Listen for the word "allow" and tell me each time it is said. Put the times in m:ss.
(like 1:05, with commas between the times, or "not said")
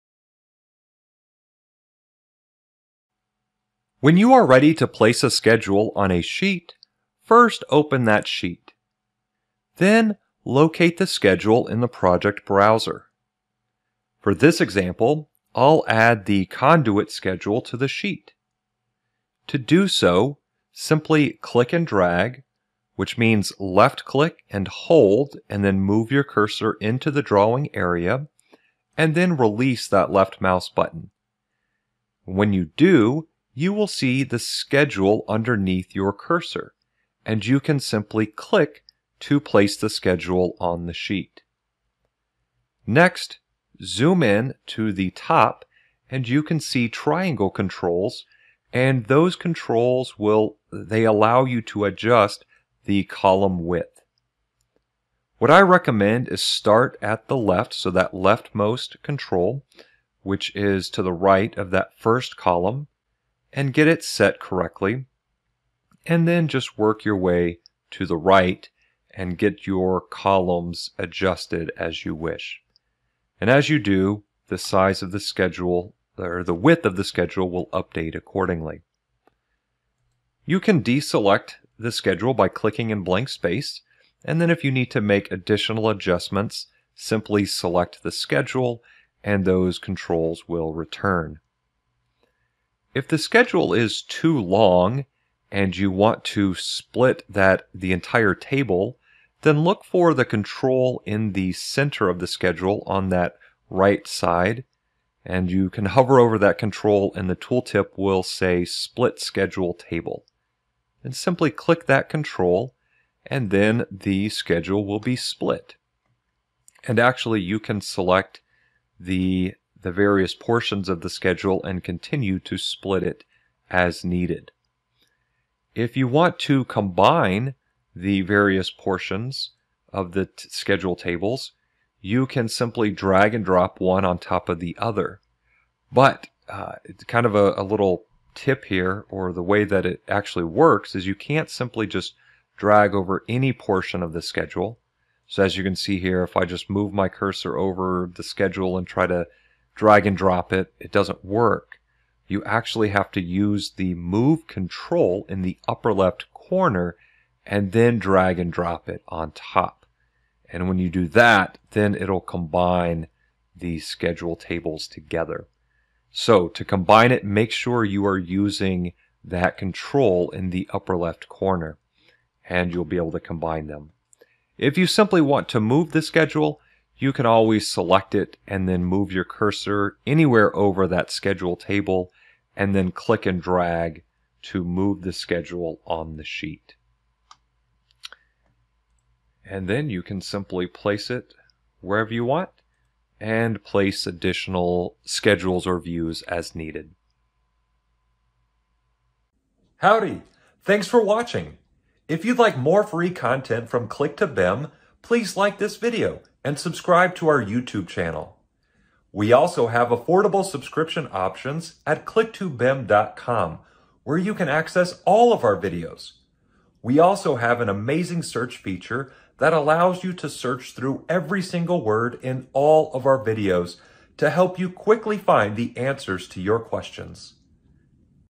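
0:51, 3:39.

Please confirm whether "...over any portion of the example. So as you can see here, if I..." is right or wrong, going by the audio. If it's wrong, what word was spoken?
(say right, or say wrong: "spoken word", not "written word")
wrong: "schedule", not "example".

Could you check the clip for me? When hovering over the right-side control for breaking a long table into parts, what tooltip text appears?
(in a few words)
Split schedule table.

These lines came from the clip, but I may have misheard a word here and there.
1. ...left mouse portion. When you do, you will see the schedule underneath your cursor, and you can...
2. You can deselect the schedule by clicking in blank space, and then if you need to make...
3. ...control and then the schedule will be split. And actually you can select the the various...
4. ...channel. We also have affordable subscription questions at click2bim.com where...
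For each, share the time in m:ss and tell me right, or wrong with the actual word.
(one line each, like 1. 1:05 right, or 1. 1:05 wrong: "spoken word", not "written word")
1. 0:30 wrong: "button", not "portion"
2. 1:20 right
3. 1:52 right
4. 3:27 wrong: "options", not "questions".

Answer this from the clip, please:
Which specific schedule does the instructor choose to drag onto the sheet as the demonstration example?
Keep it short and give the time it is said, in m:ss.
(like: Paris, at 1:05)
Conduit schedule, at 0:16.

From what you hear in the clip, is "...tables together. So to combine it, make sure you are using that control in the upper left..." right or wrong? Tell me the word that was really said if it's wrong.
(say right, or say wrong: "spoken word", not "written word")
right.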